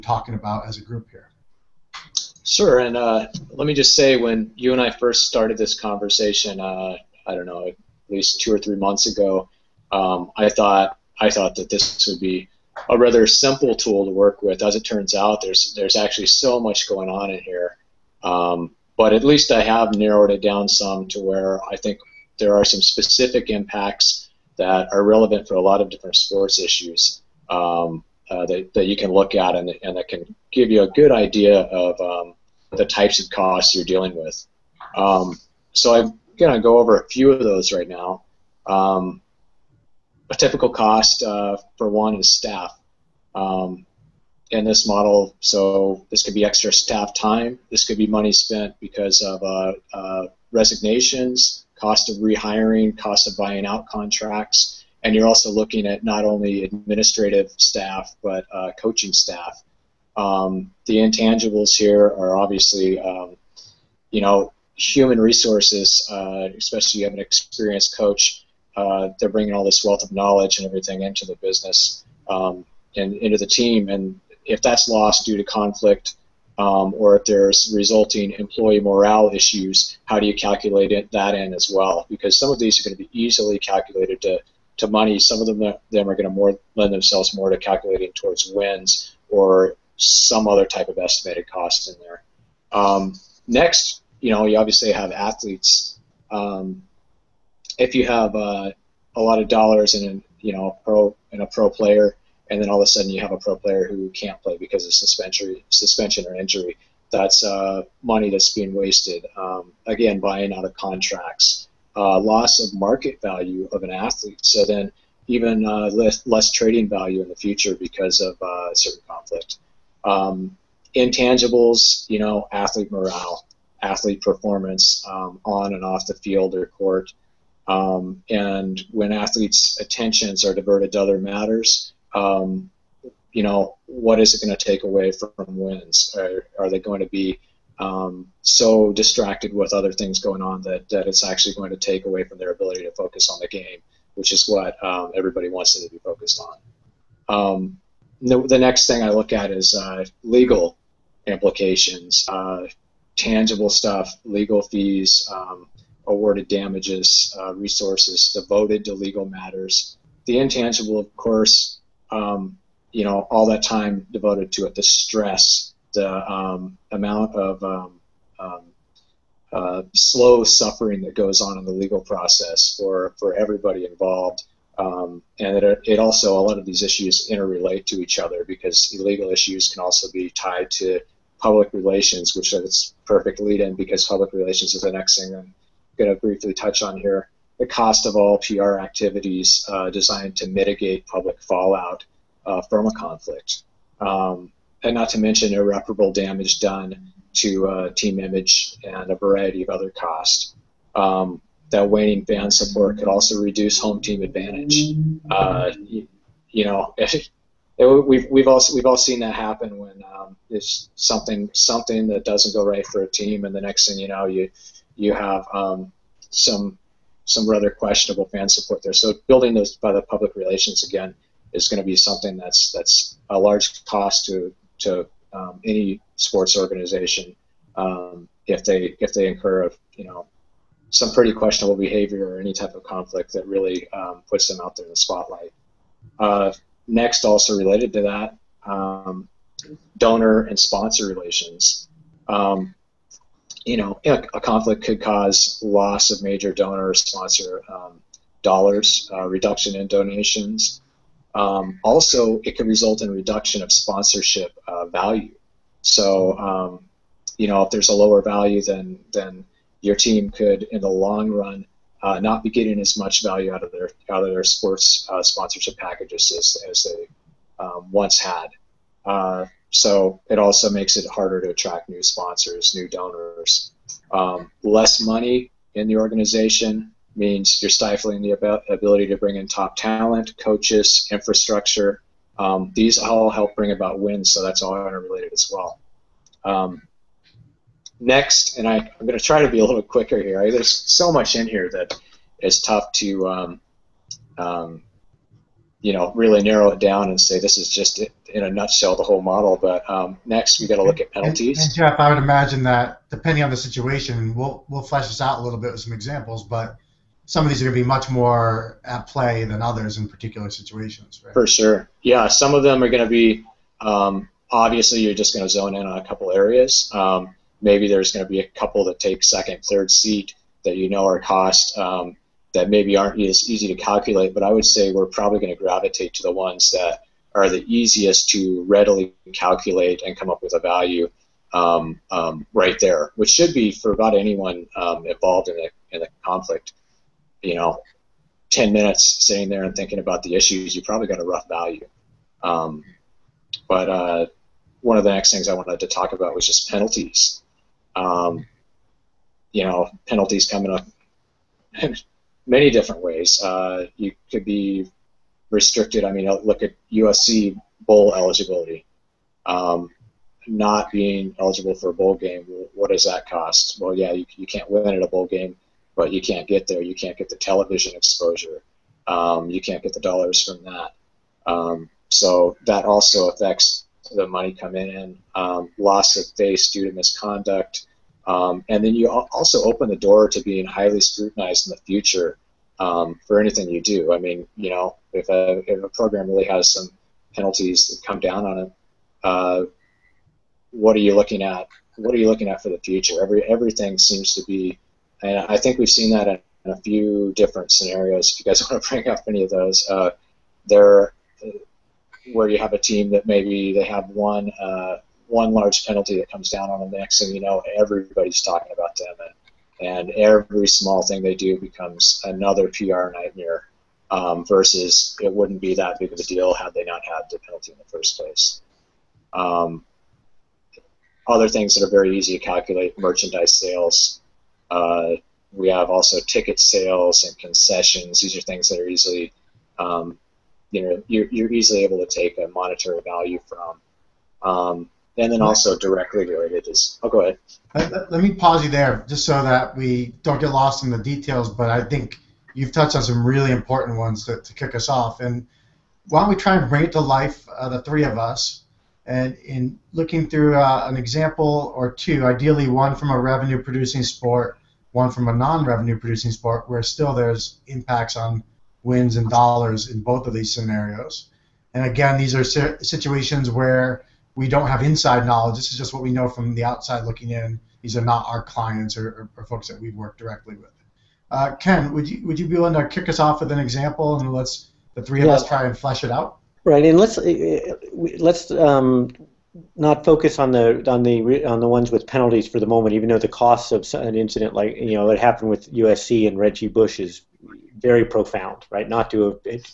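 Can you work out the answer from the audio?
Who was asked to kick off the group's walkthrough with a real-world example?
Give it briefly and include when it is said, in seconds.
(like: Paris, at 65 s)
Ken, at 471 s.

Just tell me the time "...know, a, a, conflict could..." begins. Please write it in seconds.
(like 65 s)
243 s.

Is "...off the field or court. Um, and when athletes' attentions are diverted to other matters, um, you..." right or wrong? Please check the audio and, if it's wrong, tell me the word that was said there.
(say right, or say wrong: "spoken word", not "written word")
right.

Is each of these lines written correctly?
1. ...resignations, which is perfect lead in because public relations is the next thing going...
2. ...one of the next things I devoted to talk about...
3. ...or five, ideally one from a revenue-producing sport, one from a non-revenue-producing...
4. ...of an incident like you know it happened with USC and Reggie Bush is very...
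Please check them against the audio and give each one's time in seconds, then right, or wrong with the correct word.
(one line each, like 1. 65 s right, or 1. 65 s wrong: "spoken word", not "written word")
1. 181 s wrong: "relations", not "resignations"
2. 344 s wrong: "wanted", not "devoted"
3. 451 s wrong: "two", not "five"
4. 483 s right.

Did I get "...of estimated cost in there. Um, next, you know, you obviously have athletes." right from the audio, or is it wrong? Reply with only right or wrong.
right.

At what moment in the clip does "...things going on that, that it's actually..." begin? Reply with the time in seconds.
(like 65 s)
139 s.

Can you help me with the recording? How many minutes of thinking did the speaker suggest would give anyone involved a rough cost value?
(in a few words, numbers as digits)
10.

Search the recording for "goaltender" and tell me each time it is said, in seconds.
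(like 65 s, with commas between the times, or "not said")
not said.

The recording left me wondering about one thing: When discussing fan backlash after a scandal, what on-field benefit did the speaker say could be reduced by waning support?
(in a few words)
home team advantage.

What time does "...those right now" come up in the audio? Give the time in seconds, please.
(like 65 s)
37 s.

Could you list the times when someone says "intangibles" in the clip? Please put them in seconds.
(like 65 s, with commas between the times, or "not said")
60 s, 120 s, 160 s.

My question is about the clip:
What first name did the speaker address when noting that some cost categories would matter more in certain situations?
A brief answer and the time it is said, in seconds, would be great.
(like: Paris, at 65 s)
Jeff, at 301 s.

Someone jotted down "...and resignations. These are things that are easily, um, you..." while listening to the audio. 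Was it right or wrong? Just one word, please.
wrong.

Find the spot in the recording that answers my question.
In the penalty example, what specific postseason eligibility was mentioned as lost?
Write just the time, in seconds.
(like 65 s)
357 s.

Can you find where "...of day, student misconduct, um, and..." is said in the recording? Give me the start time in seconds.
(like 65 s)
376 s.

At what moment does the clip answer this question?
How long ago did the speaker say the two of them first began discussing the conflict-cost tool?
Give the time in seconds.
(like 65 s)
8 s.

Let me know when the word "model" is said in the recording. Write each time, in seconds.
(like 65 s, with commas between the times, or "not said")
44 s, 299 s.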